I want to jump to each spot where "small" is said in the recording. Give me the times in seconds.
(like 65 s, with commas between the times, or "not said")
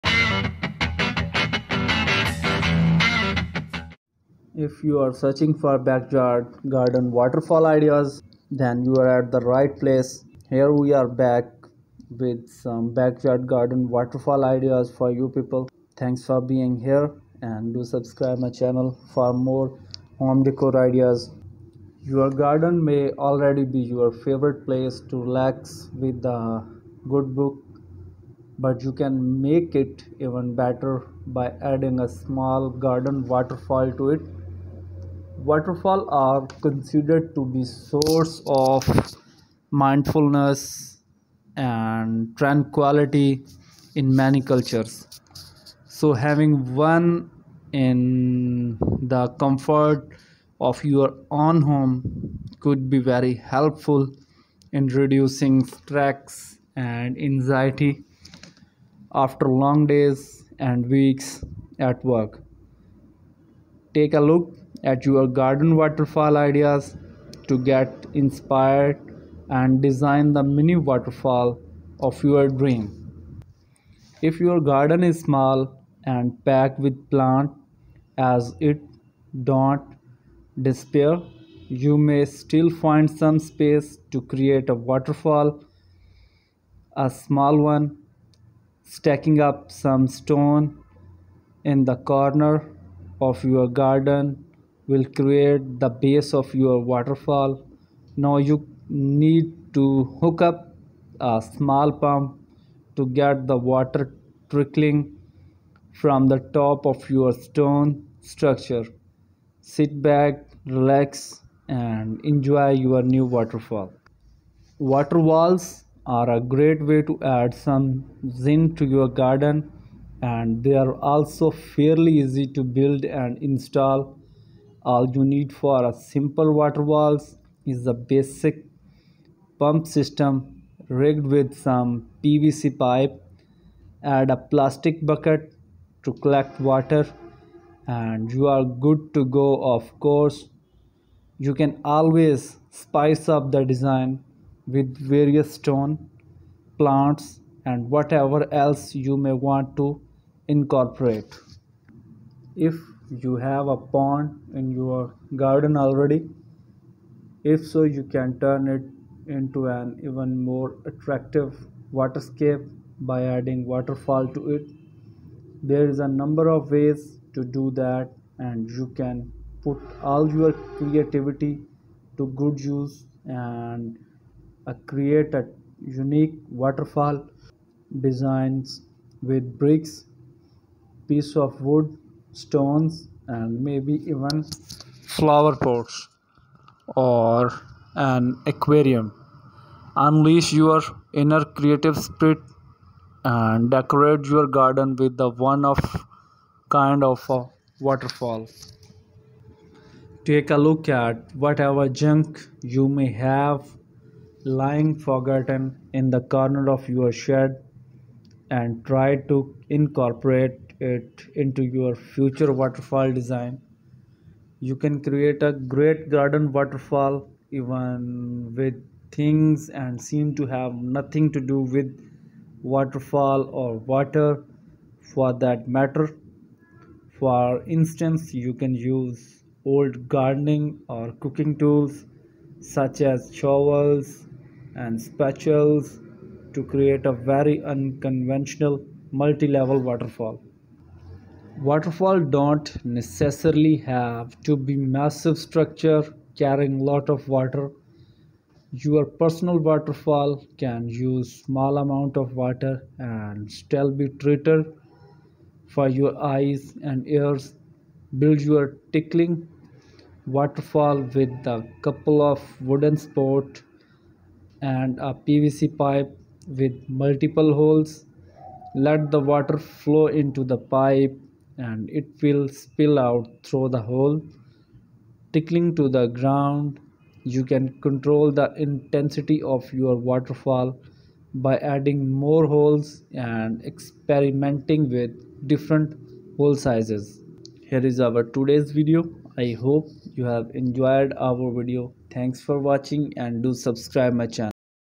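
32 s, 75 s, 87 s, 101 s, 251 s.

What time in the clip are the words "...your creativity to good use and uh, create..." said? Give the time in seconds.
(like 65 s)
170 s.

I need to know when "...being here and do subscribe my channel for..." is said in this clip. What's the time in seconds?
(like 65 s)
16 s.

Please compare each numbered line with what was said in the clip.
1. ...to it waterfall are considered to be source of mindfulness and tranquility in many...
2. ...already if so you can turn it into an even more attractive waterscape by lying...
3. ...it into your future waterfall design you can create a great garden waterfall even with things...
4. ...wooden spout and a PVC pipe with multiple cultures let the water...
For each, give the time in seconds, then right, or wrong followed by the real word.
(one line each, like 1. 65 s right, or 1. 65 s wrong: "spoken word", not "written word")
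1. 33 s right
2. 155 s wrong: "adding", not "lying"
3. 210 s right
4. 262 s wrong: "holes", not "cultures".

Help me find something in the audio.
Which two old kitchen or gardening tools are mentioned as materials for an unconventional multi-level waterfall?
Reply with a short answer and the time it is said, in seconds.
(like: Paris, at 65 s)
shovels and spatulas, at 233 s.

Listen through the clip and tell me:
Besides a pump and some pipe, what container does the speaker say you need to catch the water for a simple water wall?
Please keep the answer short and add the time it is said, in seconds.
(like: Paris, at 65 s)
plastic bucket, at 134 s.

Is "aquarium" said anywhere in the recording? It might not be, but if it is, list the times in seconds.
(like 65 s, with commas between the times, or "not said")
188 s.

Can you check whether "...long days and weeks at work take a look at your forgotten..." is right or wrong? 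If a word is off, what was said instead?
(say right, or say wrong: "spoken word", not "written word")
wrong: "garden", not "forgotten".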